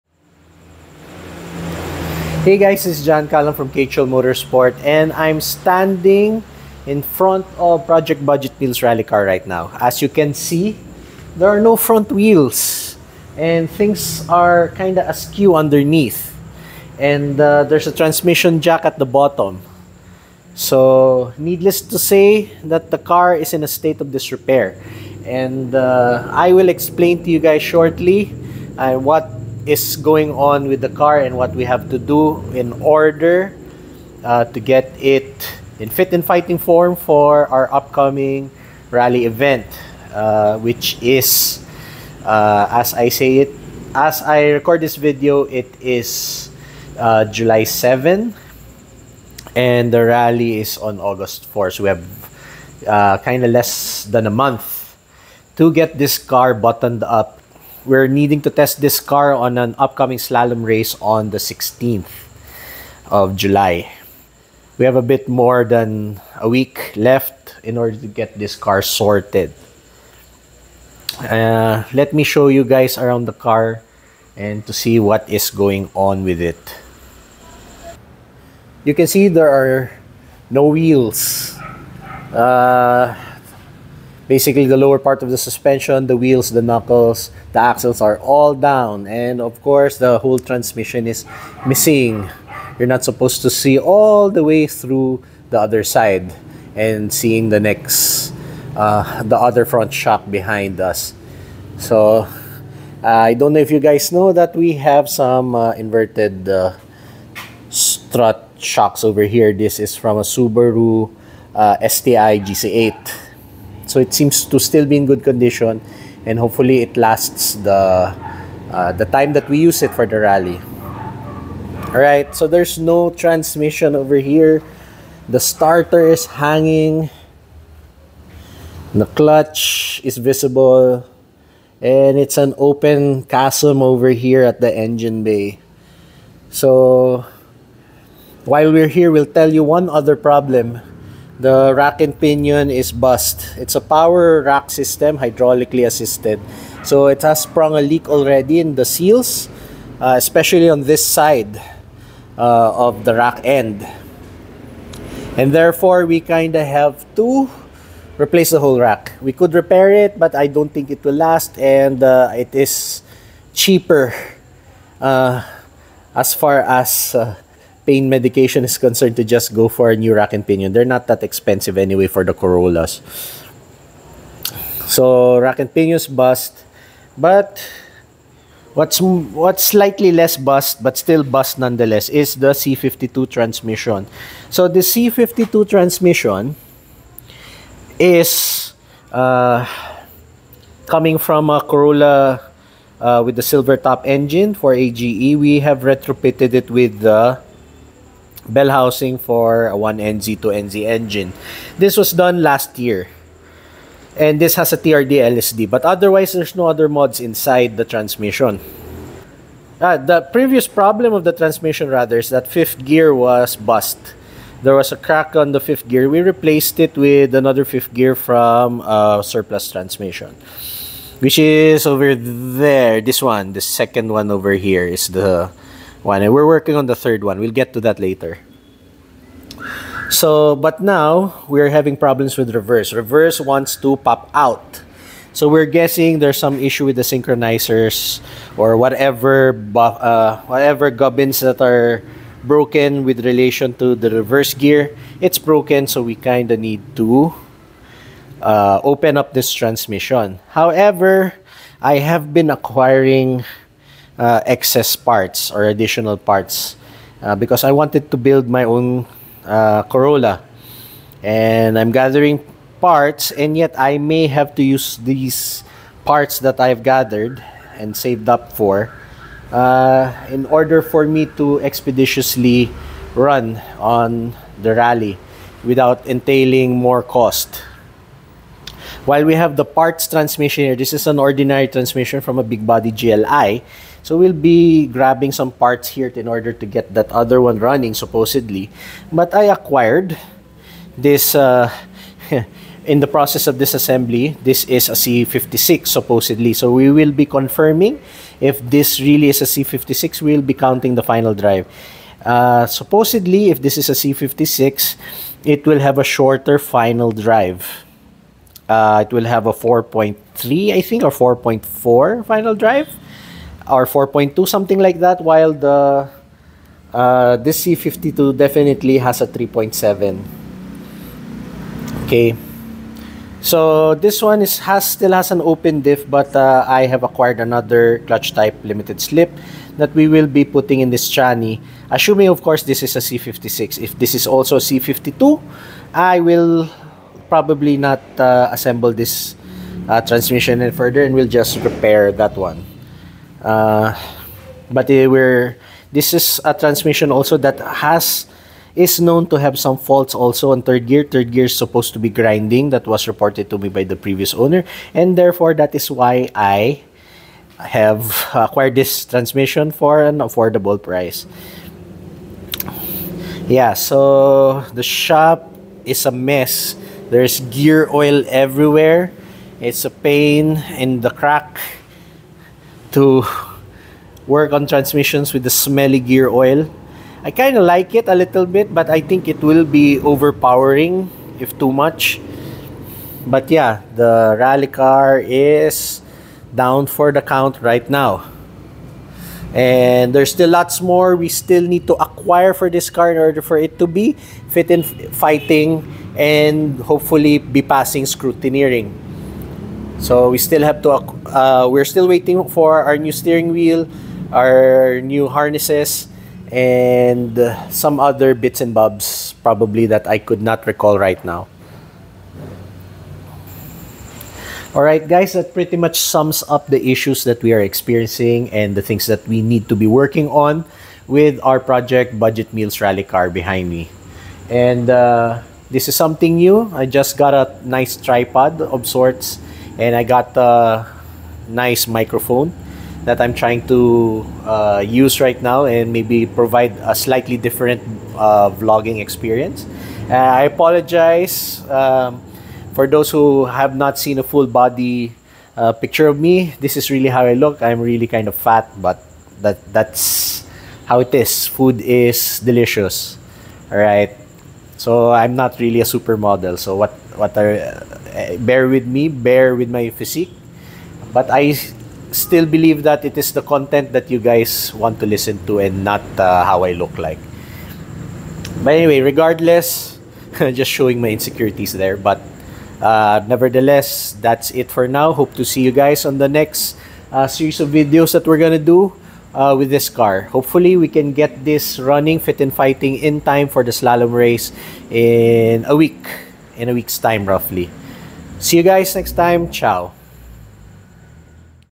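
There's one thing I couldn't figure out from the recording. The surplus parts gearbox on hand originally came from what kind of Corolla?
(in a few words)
big body GLI.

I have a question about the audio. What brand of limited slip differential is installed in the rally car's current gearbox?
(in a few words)
TRD.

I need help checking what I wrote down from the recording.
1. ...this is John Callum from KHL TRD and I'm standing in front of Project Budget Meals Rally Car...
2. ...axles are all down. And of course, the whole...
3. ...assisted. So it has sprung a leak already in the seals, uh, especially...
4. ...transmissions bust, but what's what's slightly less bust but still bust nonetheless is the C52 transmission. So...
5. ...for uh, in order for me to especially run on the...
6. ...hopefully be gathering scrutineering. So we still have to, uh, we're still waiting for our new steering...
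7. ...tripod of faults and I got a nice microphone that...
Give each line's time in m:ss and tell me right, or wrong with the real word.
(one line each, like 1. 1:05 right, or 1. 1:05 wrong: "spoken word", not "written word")
1. 0:02 wrong: "Motorsport", not "TRD"
2. 1:27 right
3. 2:25 right
4. 2:55 wrong: "pinions", not "transmissions"
5. 4:28 wrong: "expeditiously", not "especially"
6. 6:36 wrong: "passing", not "gathering"
7. 7:07 wrong: "sorts", not "faults".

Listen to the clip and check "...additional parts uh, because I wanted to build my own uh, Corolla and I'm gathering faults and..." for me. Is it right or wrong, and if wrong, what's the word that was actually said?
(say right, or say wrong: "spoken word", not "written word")
wrong: "parts", not "faults".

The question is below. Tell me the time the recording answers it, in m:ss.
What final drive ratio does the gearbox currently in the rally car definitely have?
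5:19.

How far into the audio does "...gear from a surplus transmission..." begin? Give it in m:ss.
3:37.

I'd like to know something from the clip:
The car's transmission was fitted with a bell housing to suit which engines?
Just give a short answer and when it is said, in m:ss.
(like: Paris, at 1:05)
1NZ, 2NZ, at 3:19.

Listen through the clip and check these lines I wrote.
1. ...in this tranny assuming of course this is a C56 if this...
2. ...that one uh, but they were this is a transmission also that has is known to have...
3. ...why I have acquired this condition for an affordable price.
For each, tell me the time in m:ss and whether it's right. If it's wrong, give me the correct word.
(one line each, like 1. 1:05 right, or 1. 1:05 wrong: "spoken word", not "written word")
1. 5:30 right
2. 5:42 right
3. 5:55 wrong: "transmission", not "condition".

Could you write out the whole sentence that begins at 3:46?
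And we're working on the third one.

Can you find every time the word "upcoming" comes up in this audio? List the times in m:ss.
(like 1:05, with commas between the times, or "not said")
0:37, 0:59.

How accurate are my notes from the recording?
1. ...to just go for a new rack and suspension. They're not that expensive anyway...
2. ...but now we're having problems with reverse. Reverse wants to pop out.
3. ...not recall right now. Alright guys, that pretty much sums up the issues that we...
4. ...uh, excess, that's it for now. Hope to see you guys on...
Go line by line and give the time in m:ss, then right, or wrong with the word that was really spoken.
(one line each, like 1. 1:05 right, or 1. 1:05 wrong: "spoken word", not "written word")
1. 2:49 wrong: "pinion", not "suspension"
2. 3:50 right
3. 6:50 right
4. 7:52 wrong: "nevertheless", not "excess".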